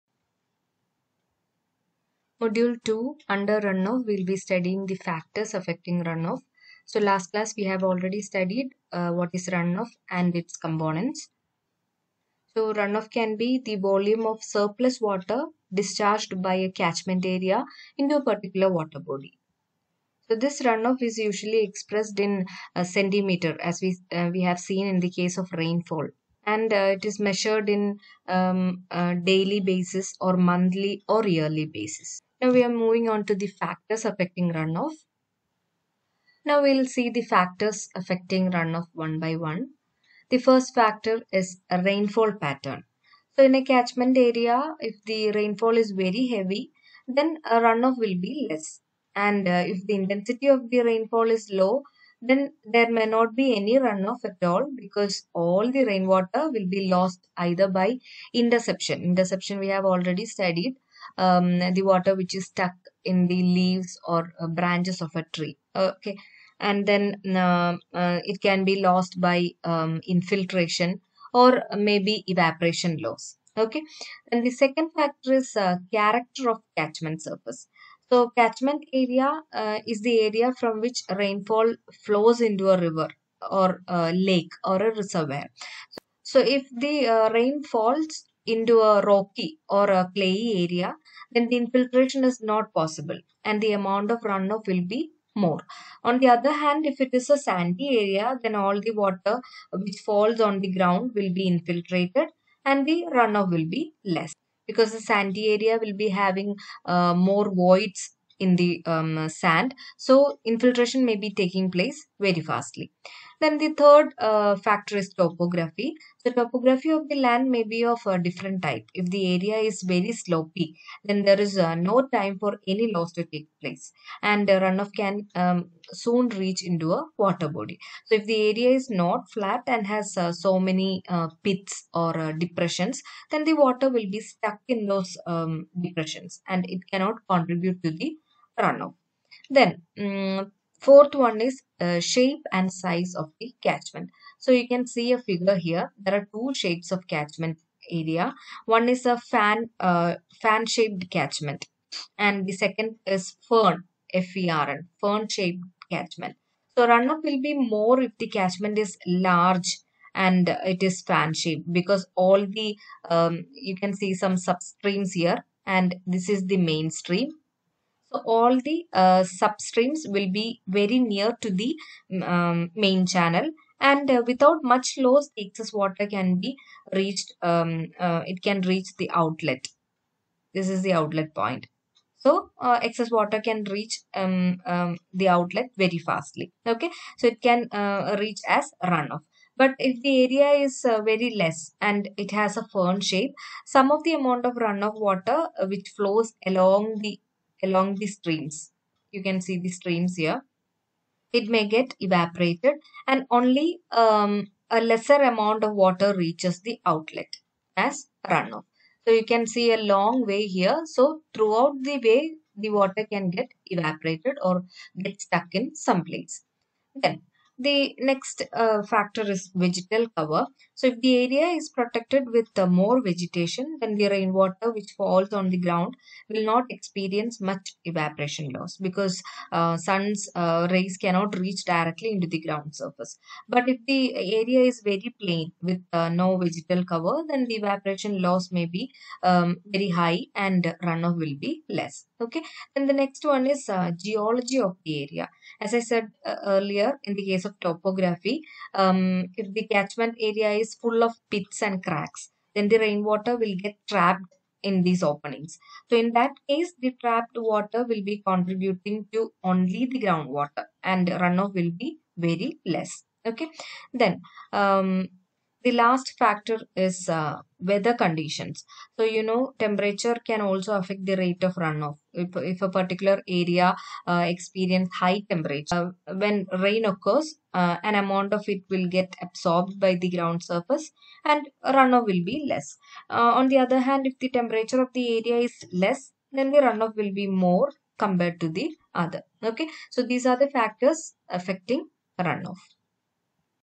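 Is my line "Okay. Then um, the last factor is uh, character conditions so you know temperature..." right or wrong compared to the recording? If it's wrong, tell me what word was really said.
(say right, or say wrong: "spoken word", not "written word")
wrong: "weather", not "character".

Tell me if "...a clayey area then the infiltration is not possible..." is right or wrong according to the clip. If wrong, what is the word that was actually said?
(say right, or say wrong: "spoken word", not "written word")
right.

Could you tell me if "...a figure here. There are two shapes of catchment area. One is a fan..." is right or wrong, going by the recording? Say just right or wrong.
right.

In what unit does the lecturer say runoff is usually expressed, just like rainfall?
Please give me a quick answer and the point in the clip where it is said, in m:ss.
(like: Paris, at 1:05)
centimeter, at 0:22.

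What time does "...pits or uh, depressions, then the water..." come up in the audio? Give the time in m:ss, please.
2:11.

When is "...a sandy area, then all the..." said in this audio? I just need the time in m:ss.
1:37.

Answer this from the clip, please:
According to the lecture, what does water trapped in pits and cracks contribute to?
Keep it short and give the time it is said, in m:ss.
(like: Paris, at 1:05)
groundwater, at 4:19.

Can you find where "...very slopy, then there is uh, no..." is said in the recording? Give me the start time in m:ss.
1:59.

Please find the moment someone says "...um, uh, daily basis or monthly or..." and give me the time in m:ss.
0:28.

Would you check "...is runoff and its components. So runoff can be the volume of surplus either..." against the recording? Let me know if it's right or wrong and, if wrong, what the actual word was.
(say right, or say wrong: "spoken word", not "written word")
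wrong: "water", not "either".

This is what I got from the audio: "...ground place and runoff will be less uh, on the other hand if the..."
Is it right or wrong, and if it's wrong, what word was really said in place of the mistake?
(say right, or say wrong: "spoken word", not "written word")
wrong: "surface", not "place".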